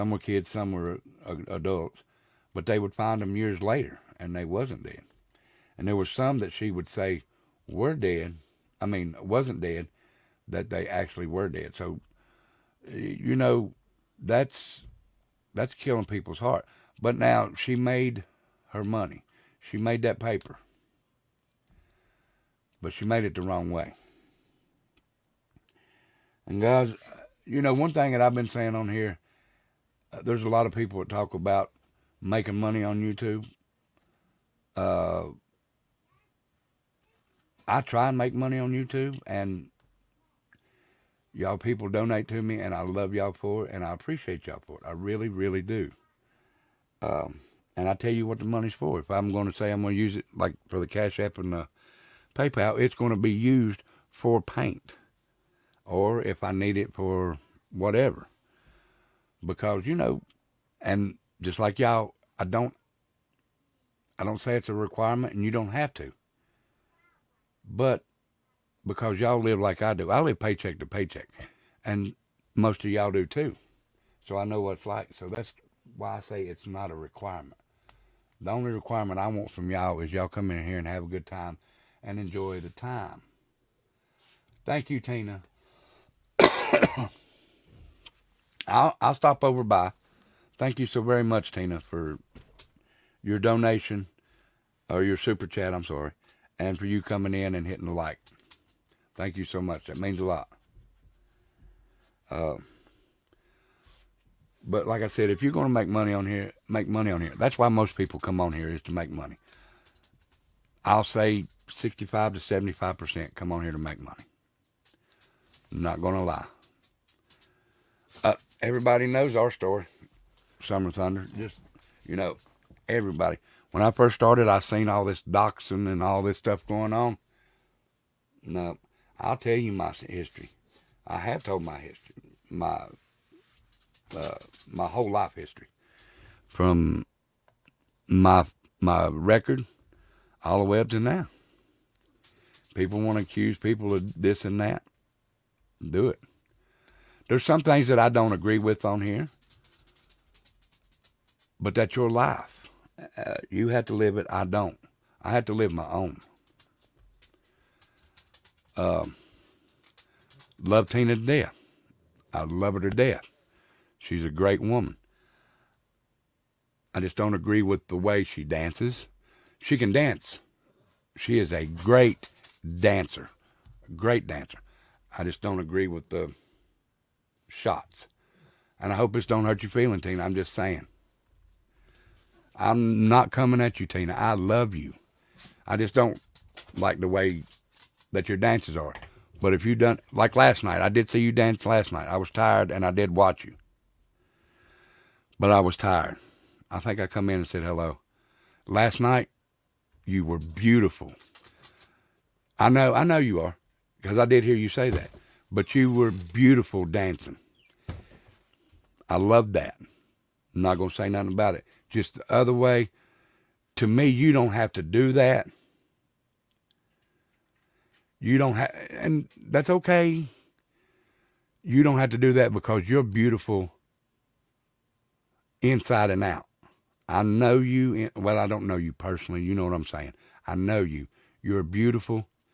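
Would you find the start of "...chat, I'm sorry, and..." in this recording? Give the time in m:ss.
1:35.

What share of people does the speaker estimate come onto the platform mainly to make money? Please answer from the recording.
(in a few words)
65 to 75%.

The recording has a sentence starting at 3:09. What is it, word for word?
But if you done like last night, I did see you dance last night.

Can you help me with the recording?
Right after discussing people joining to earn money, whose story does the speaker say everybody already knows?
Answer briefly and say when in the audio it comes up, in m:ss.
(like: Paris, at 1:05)
Summer Thunder, at 2:00.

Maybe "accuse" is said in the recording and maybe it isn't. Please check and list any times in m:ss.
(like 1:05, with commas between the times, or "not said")
2:23.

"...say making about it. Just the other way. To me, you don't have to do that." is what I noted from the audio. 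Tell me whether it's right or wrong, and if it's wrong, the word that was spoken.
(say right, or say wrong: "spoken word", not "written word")
wrong: "nothing", not "making".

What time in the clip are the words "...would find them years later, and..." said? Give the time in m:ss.
0:02.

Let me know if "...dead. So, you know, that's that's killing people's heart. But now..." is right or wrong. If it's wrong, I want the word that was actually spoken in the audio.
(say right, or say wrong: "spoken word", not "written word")
right.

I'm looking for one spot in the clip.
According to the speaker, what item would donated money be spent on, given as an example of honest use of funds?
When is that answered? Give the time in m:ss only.
0:54.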